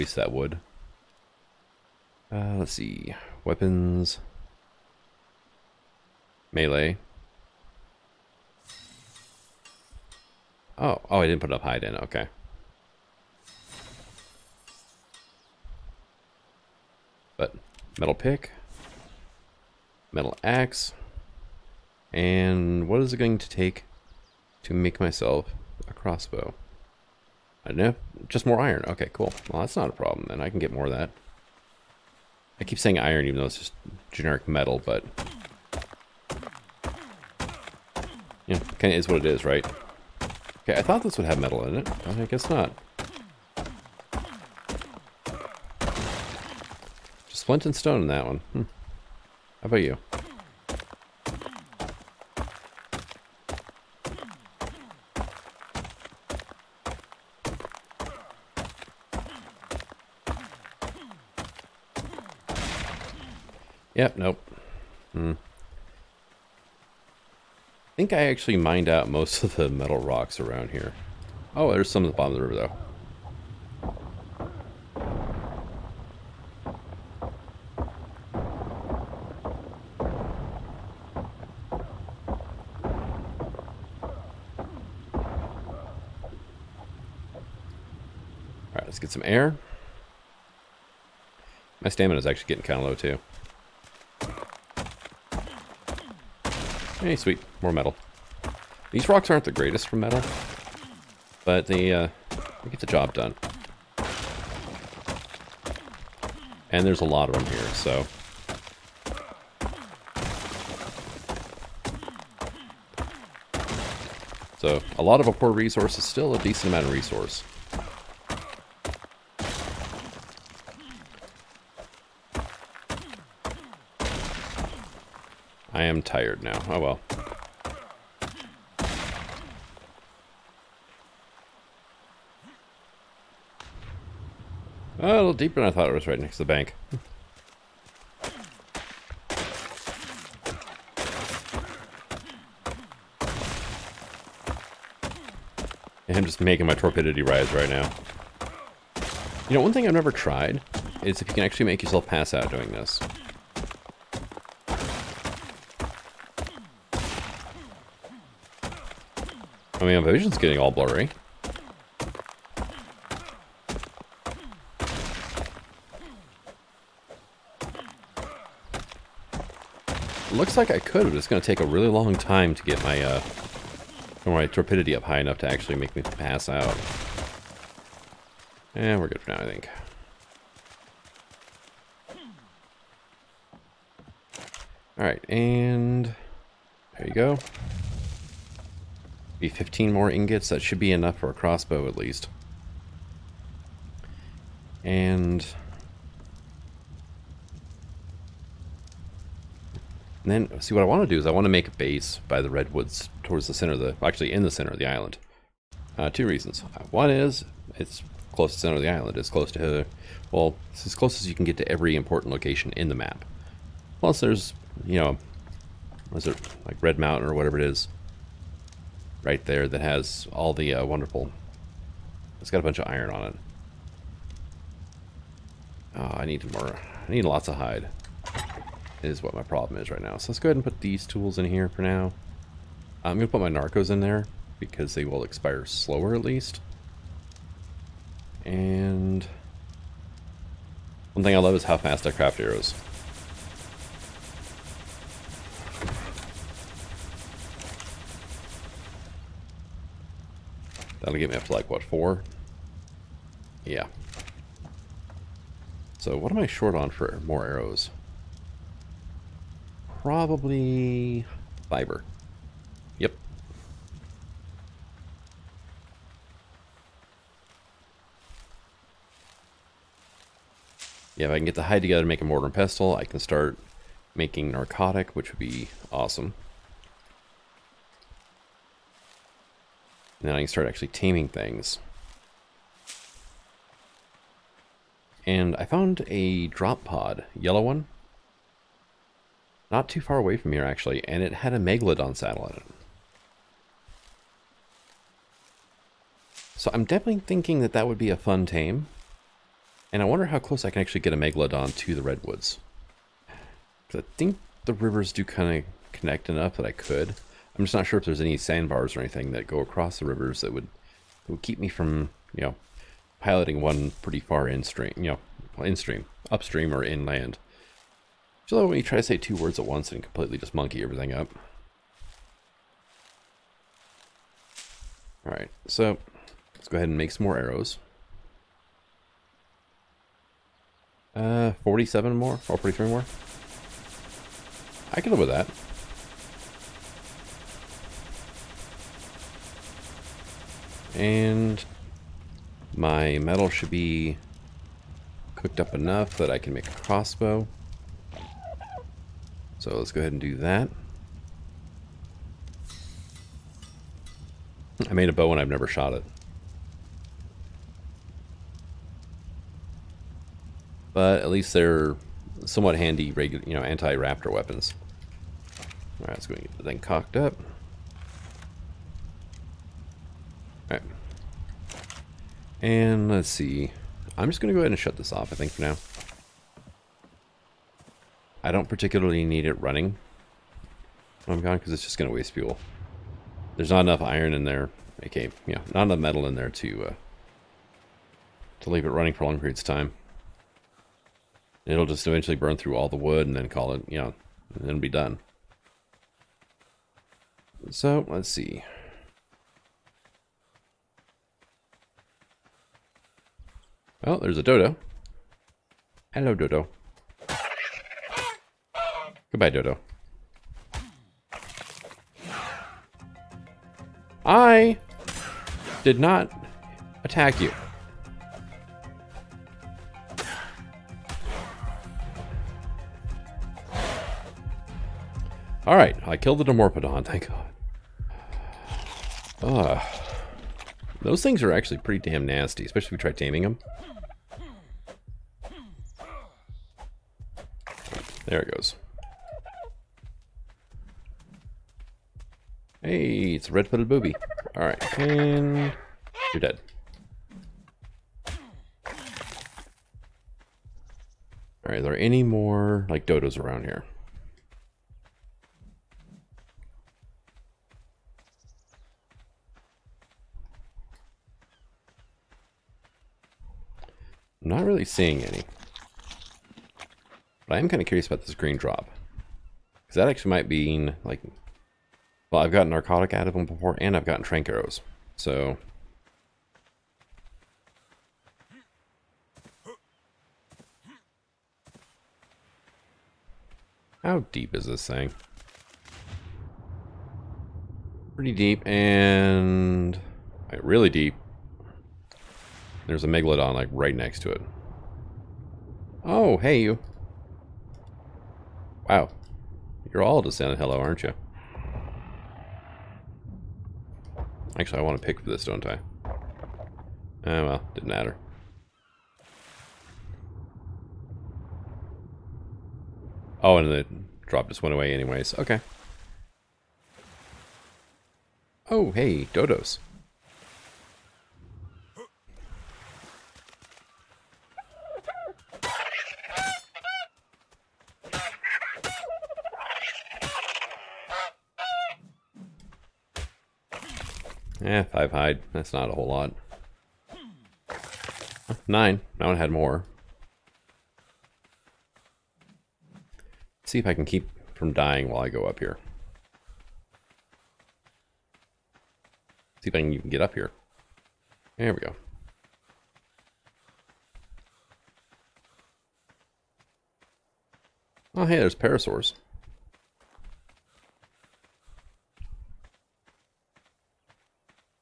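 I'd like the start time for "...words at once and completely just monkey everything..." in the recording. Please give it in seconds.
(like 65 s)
319 s.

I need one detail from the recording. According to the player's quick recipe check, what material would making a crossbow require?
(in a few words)
More iron.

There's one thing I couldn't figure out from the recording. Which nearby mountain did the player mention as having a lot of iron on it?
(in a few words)
Red Mountain.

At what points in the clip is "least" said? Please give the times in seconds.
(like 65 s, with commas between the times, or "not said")
191 s, 236 s, 361 s.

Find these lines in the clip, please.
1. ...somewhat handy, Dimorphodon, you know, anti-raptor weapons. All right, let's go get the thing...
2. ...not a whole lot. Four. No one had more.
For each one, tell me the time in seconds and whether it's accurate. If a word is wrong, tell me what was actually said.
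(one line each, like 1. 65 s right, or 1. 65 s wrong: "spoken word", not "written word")
1. 362 s wrong: "Regular", not "Dimorphodon"
2. 535 s wrong: "Nine", not "Four".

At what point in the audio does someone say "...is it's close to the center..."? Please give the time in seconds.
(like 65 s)
207 s.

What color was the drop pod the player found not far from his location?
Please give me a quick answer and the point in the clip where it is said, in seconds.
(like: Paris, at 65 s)
Yellow, at 287 s.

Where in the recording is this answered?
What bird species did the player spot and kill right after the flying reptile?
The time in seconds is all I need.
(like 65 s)
443 s.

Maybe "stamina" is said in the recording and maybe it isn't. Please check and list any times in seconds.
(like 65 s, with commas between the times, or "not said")
91 s.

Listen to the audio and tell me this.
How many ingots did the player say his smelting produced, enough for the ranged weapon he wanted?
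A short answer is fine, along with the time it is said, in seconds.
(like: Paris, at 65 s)
15, at 189 s.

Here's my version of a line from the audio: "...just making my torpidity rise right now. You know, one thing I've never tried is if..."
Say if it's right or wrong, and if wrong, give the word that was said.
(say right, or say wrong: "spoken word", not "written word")
right.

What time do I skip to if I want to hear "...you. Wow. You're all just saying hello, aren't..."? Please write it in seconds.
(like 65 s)
496 s.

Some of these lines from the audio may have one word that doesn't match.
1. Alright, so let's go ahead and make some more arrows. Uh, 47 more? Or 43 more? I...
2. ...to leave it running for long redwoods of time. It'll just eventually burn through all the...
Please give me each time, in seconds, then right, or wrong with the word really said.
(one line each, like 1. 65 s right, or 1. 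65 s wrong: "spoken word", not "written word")
1. 325 s right
2. 388 s wrong: "periods", not "redwoods".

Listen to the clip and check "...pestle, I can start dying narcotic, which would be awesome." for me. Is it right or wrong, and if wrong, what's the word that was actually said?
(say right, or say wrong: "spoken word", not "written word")
wrong: "making", not "dying".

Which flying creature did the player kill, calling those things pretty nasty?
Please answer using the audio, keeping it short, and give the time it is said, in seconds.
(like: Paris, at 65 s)
Dimorphodon, at 426 s.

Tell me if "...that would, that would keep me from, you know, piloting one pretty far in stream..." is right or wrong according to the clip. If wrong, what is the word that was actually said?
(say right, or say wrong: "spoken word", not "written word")
right.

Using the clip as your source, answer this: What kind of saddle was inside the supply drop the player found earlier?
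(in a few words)
Megalodon saddle.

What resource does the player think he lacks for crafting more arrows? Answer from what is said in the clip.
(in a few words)
Fiber.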